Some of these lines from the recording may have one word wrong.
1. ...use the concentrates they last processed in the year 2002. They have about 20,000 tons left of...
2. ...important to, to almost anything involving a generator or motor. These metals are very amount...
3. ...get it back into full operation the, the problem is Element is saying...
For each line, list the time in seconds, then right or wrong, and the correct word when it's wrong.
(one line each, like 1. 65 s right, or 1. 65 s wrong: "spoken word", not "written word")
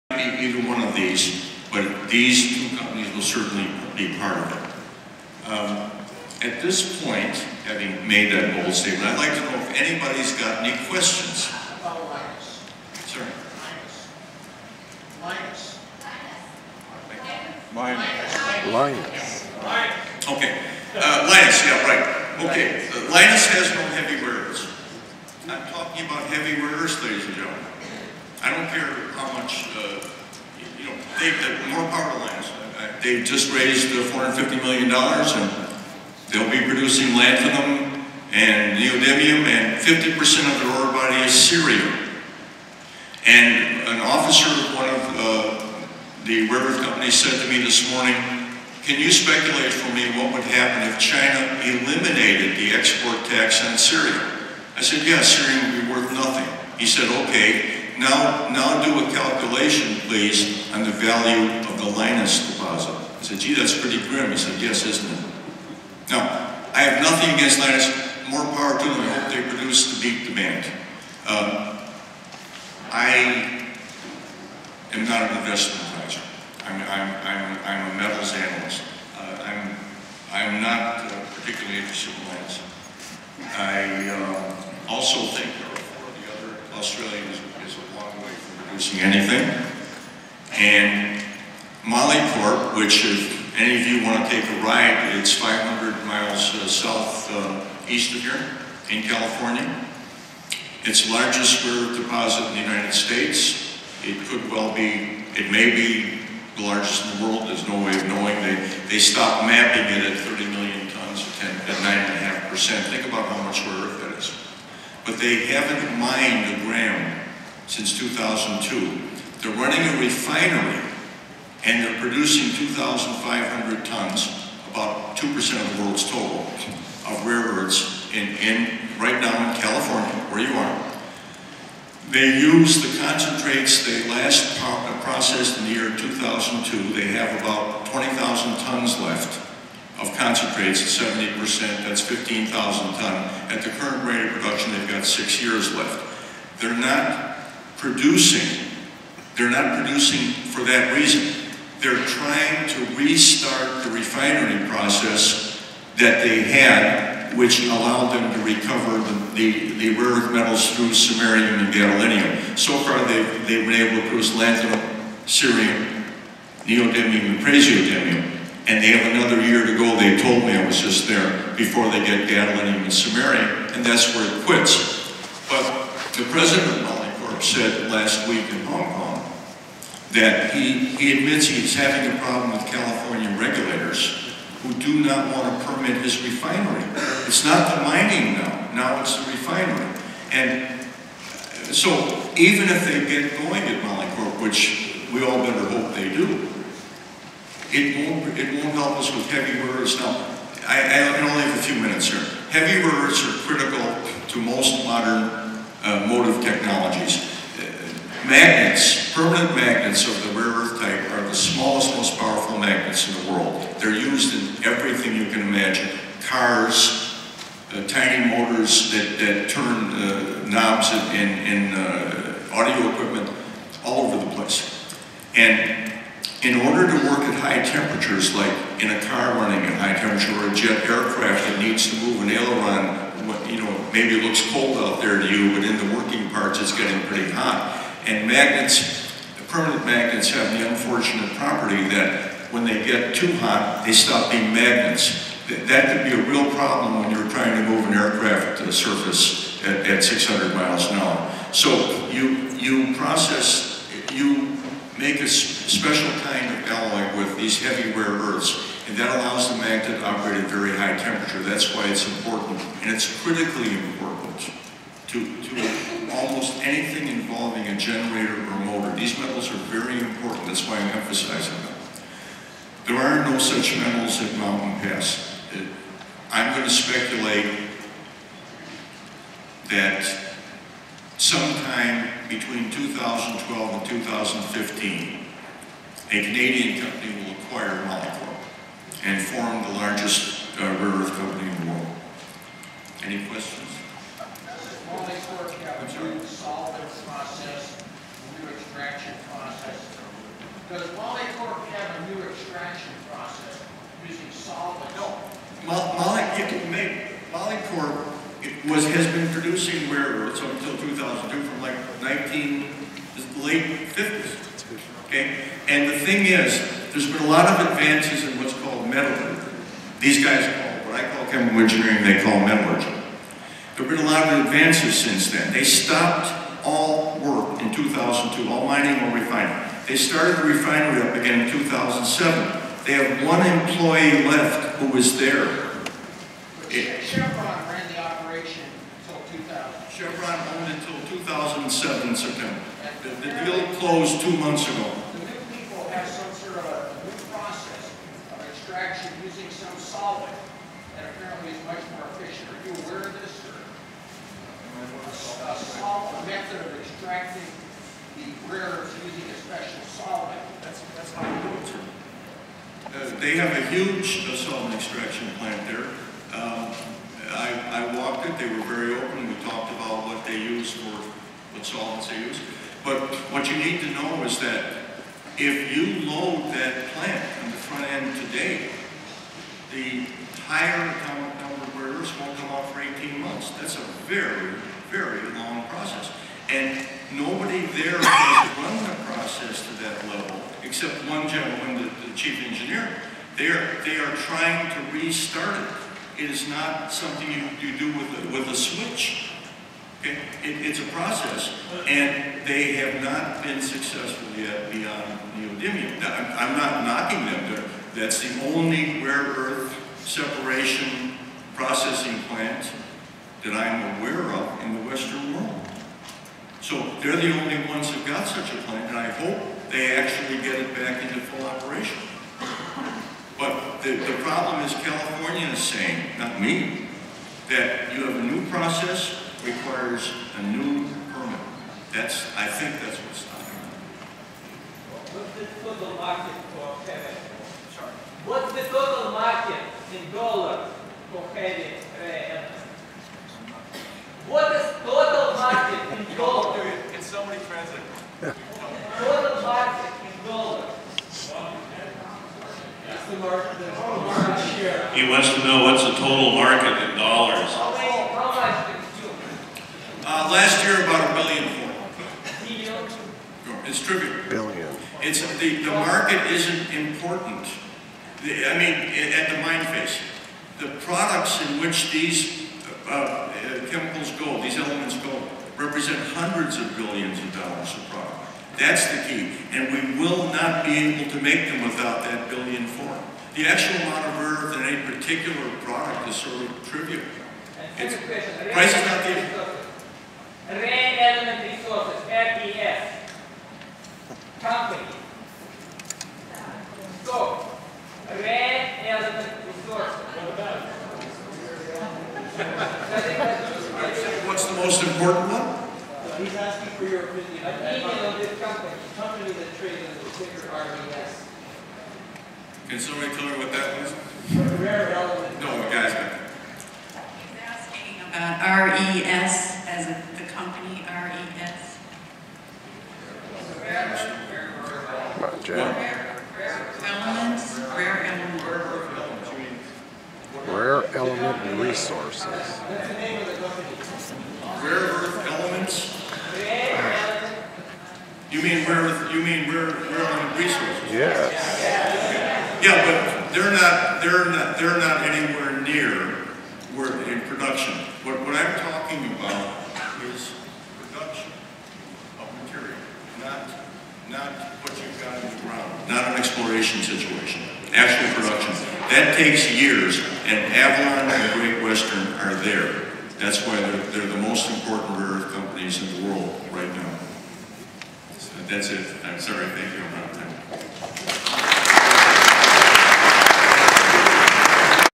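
1. 132 s right
2. 263 s wrong: "important", not "amount"
3. 420 s wrong: "California", not "Element".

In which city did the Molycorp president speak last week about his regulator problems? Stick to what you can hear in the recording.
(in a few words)
Hong Kong.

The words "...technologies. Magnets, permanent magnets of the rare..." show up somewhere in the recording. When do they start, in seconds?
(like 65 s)
206 s.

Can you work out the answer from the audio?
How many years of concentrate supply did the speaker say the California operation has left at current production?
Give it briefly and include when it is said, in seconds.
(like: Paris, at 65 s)
6, at 145 s.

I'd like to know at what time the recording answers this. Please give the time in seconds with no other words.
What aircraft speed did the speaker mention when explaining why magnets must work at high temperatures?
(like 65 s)
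250 s.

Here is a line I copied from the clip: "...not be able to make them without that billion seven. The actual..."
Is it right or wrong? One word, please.
wrong.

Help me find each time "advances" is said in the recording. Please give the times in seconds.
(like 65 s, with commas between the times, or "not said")
317 s, 324 s.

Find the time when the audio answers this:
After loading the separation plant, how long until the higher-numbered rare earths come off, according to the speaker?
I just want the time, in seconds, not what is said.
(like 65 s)
382 s.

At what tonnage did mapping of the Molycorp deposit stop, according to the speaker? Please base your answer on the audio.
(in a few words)
30 million tons.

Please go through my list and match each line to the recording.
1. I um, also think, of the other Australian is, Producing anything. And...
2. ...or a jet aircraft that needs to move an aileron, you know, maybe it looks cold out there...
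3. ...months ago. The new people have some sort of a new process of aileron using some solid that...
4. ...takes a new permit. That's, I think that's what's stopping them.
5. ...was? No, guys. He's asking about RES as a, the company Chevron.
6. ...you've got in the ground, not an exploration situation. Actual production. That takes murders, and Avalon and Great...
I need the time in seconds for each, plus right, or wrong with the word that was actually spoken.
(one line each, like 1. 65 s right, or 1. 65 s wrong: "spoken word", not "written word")
1. 83 s right
2. 230 s right
3. 344 s wrong: "extraction", not "aileron"
4. 429 s wrong: "requires", not "takes"
5. 513 s wrong: "RES", not "Chevron"
6. 554 s wrong: "years", not "murders".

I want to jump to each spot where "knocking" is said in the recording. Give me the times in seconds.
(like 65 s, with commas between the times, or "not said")
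406 s.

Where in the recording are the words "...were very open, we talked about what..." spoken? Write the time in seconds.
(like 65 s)
368 s.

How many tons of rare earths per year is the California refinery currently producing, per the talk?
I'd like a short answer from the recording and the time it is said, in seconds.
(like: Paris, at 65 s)
2,500 tons, at 122 s.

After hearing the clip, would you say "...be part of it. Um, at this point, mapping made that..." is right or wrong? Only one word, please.
wrong.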